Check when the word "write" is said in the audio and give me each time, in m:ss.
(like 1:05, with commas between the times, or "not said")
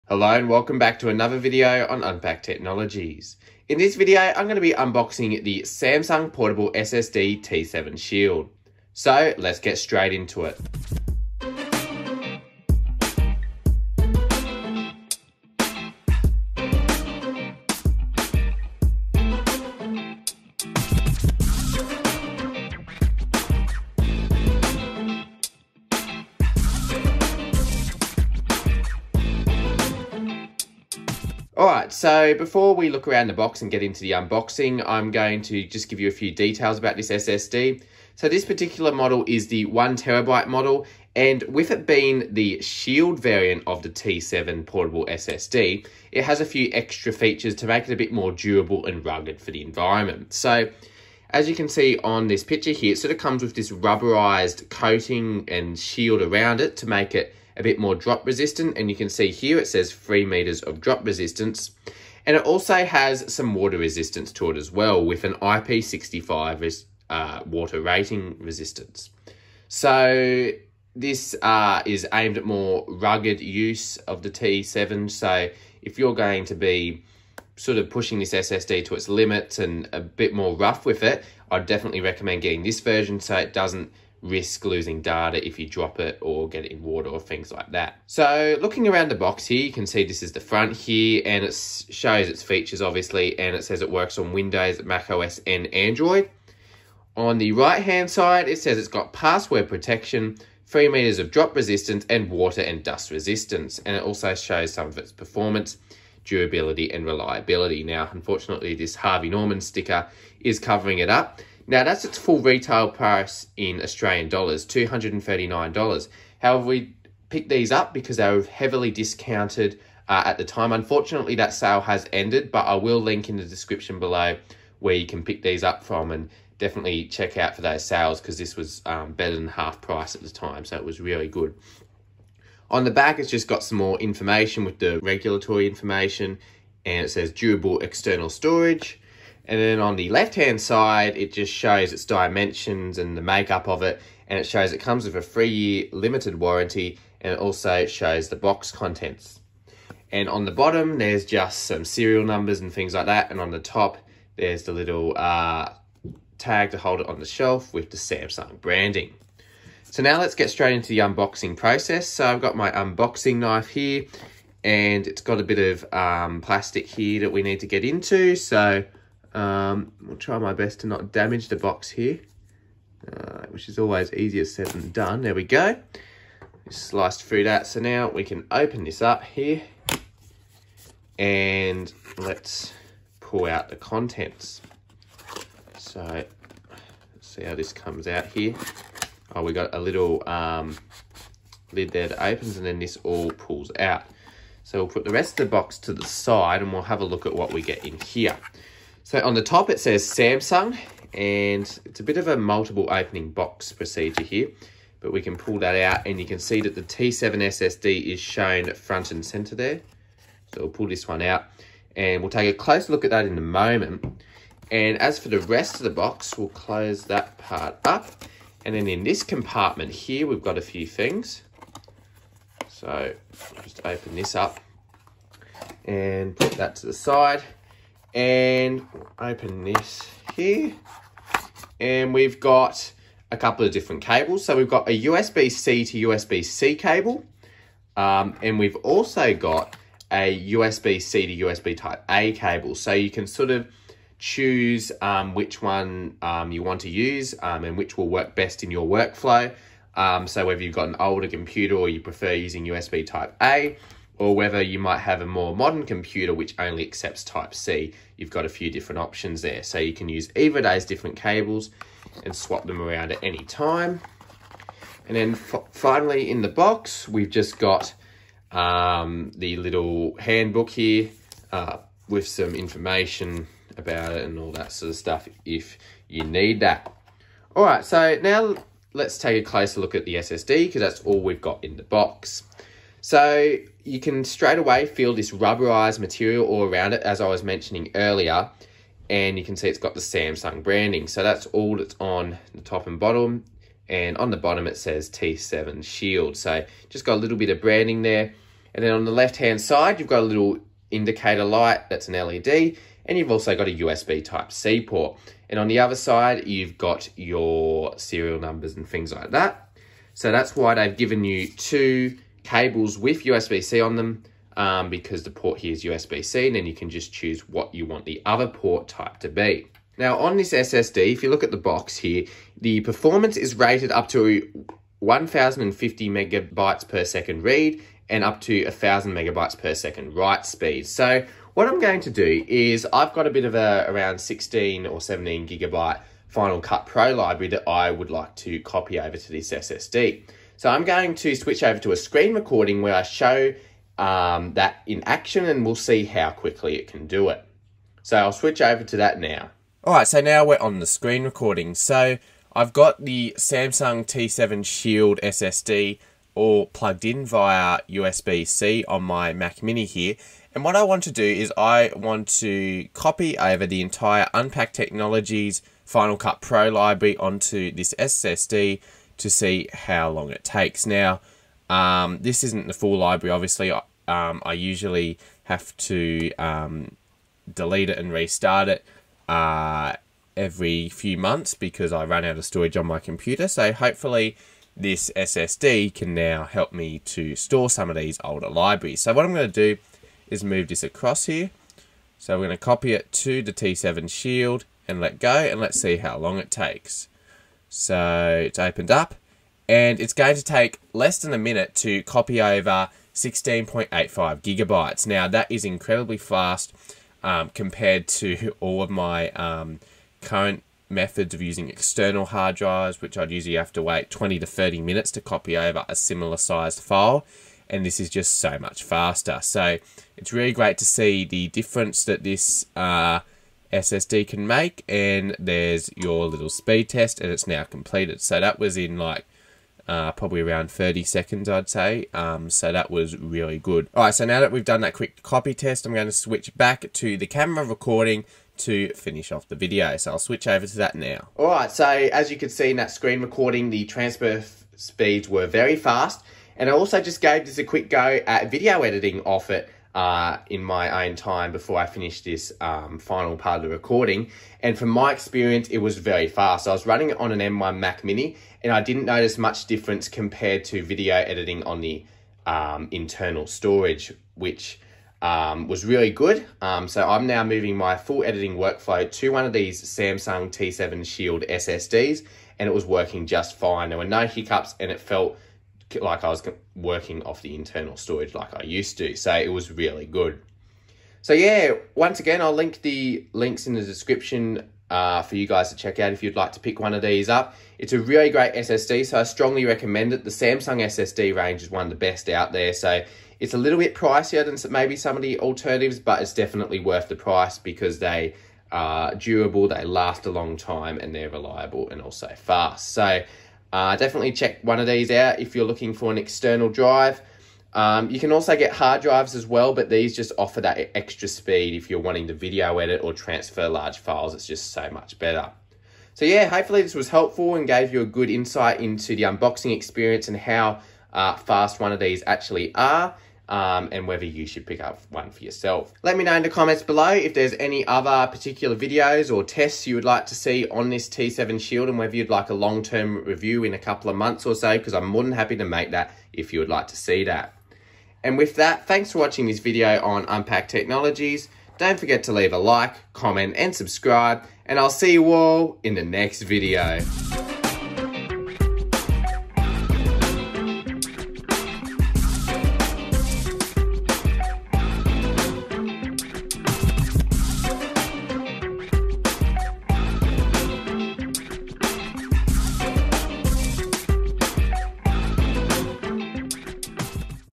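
5:30.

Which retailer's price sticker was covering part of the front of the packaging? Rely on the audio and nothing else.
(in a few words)
Harvey Norman.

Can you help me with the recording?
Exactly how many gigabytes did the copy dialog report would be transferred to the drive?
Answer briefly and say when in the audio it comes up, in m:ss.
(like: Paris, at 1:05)
16.85, at 6:43.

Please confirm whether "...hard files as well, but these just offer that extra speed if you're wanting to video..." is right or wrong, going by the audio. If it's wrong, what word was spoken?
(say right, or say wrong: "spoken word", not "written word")
wrong: "drives", not "files".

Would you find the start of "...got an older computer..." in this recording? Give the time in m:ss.
4:10.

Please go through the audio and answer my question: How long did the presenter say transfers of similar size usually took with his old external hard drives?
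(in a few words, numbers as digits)
20 to 30 minutes.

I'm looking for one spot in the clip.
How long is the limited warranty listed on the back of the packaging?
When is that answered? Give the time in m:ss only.
2:25.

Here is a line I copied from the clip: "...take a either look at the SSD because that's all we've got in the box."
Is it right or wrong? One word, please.
wrong.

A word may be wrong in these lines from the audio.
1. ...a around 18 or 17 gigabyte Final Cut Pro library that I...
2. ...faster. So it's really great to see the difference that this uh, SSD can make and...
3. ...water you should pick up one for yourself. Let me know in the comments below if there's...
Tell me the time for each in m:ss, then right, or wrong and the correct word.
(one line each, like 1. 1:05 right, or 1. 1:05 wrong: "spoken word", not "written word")
1. 5:33 wrong: "16", not "18"
2. 6:58 right
3. 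8:44 wrong: "whether", not "water".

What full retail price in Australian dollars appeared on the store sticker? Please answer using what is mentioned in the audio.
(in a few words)
$239.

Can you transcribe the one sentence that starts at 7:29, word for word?
Uh, in my own time before I finished this um, final part of the recording.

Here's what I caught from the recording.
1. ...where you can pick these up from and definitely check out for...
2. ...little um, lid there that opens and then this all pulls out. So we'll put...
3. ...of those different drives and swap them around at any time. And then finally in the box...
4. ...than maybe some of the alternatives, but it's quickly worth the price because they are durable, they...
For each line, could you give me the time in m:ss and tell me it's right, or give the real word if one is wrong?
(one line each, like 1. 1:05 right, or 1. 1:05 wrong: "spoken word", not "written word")
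1. 2:04 right
2. 3:09 right
3. 4:20 wrong: "cables", not "drives"
4. 8:14 wrong: "definitely", not "quickly".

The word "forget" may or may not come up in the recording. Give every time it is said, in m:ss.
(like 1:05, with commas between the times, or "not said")
9:01.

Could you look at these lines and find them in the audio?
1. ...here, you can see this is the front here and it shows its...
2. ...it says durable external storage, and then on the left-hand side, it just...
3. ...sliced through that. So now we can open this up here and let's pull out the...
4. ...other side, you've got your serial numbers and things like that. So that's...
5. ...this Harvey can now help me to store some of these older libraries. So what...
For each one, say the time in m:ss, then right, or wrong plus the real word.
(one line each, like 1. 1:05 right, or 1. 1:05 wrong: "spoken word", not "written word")
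1. 1:29 right
2. 2:17 right
3. 2:56 right
4. 5:05 right
5. 6:24 wrong: "SSD", not "Harvey".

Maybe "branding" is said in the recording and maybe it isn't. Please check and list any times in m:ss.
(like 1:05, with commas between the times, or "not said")
2:38, 4:50, 4:57.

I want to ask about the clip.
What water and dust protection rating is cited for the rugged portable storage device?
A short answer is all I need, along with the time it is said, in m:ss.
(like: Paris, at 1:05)
IP65, at 1:05.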